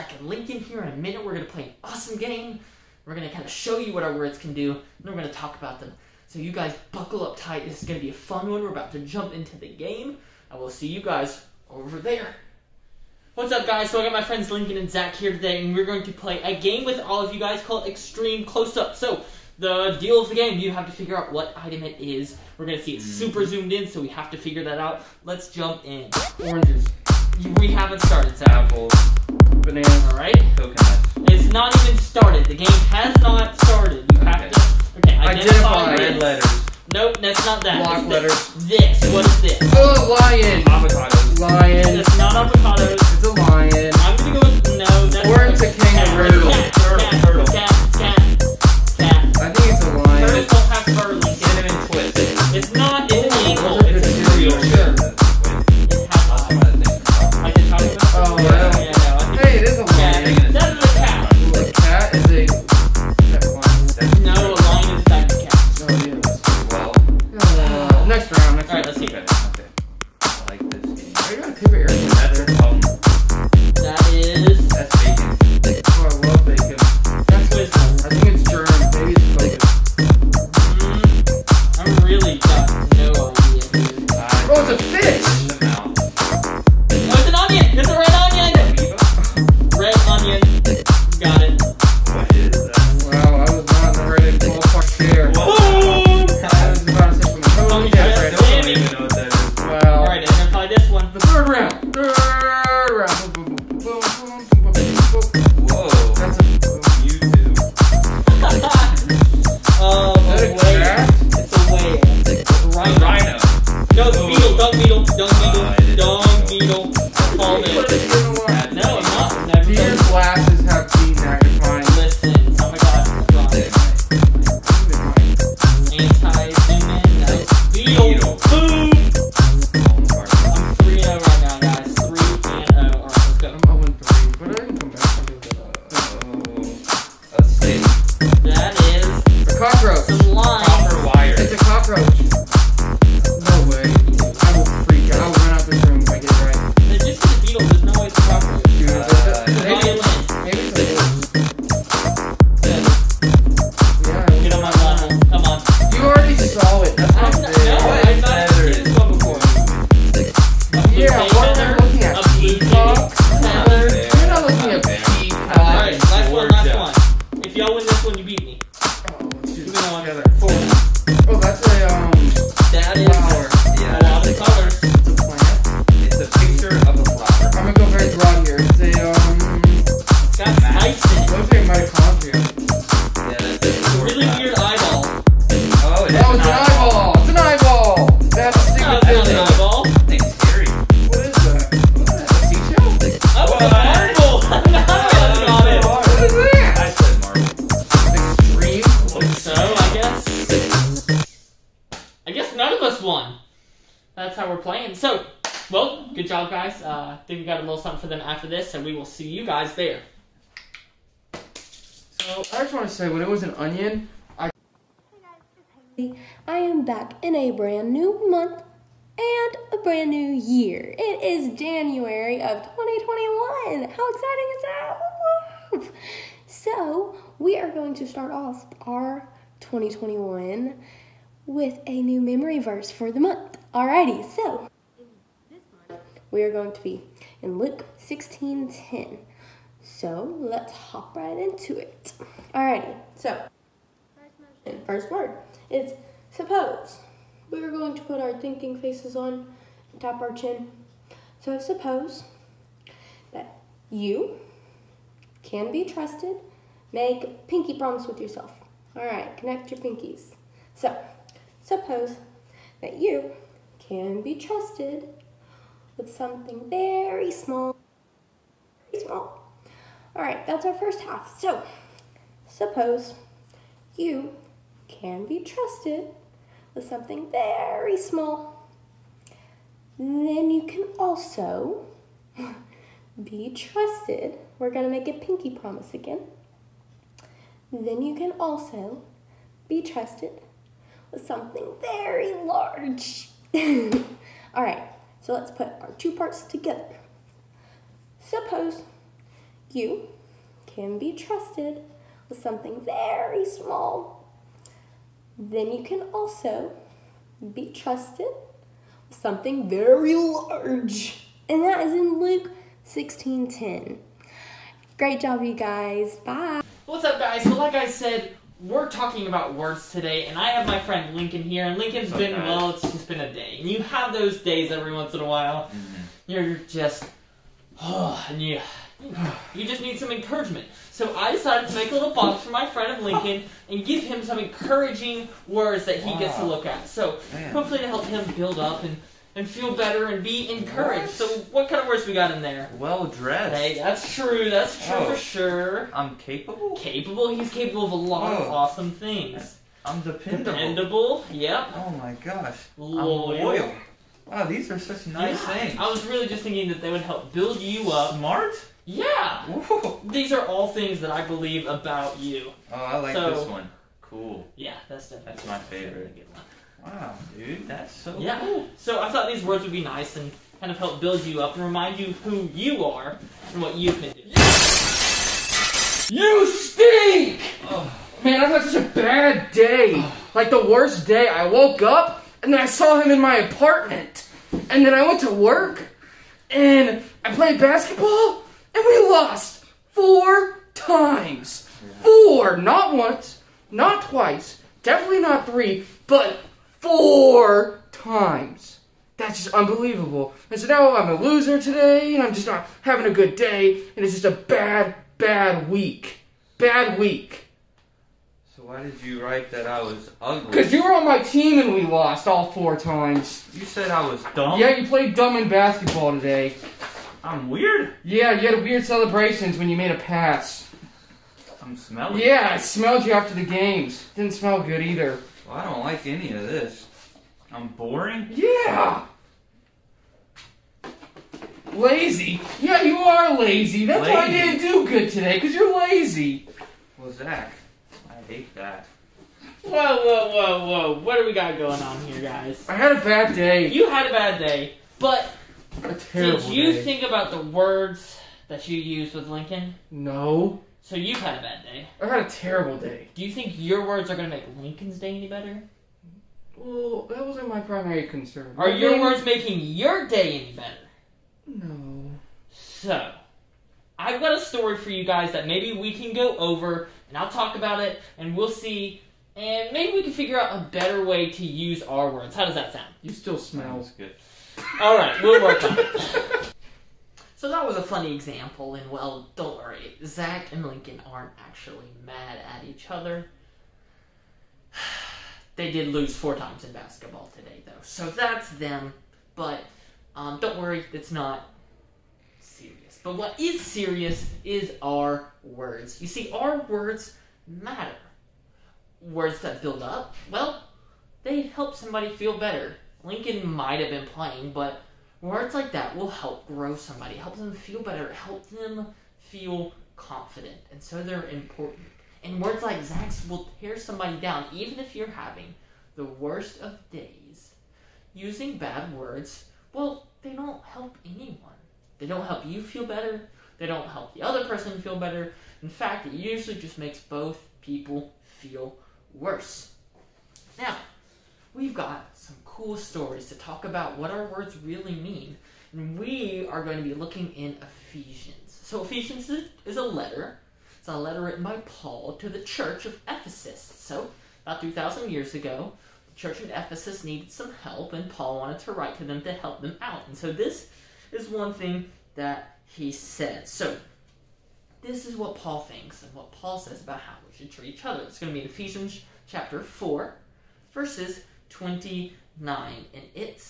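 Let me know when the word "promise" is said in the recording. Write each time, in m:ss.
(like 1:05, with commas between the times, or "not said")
4:17, 4:45.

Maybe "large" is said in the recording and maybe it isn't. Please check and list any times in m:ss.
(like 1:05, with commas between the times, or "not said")
4:52, 5:10.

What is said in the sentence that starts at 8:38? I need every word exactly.
Using bad words, well, they don't help anyone.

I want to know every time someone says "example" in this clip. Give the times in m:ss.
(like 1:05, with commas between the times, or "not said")
7:58.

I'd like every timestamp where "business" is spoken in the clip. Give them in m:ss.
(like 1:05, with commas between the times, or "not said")
not said.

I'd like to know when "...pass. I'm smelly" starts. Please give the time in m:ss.
6:59.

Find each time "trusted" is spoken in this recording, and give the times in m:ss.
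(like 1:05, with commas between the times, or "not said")
4:15, 4:24, 4:35, 4:43, 4:49, 5:01, 5:07.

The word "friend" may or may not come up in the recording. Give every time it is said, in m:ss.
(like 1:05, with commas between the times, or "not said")
0:14, 5:20, 5:32.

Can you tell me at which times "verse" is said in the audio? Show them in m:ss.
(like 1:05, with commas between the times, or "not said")
3:52, 9:20.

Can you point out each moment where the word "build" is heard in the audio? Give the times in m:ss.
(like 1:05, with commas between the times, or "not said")
5:38, 5:57, 6:11, 8:19.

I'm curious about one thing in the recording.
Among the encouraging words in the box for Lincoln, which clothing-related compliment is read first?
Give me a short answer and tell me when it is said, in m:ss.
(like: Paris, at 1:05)
Well dressed, at 5:42.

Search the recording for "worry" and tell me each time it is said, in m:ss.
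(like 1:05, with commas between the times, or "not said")
7:59, 8:10.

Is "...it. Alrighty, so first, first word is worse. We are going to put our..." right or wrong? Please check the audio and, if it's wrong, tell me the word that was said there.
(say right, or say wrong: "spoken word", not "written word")
wrong: "suppose", not "worse".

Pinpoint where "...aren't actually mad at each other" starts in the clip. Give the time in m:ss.
8:01.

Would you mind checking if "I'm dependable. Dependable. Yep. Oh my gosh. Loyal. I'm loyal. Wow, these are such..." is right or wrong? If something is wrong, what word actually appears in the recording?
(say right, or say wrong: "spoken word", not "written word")
right.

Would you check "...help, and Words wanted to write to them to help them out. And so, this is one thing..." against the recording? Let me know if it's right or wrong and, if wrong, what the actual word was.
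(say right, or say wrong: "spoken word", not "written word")
wrong: "Paul", not "Words".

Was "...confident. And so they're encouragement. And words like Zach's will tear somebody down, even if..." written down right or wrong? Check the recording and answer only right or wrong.
wrong.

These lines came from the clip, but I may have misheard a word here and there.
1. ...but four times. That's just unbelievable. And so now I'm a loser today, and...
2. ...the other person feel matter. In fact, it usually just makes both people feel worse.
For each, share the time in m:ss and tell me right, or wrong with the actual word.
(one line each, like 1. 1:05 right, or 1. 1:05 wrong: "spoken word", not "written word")
1. 6:36 right
2. 8:44 wrong: "better", not "matter".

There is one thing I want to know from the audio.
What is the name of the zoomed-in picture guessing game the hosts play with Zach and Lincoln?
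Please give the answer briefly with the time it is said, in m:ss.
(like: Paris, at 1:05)
Extreme Close-Up, at 0:17.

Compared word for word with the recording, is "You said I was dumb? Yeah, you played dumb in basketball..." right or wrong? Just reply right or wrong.
right.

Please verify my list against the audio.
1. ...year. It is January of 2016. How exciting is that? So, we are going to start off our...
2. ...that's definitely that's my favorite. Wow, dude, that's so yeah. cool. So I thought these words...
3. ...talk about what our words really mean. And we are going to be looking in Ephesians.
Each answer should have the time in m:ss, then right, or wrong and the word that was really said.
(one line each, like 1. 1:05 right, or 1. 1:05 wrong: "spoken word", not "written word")
1. 3:40 wrong: "2021", not "2016"
2. 6:04 right
3. 8:53 right.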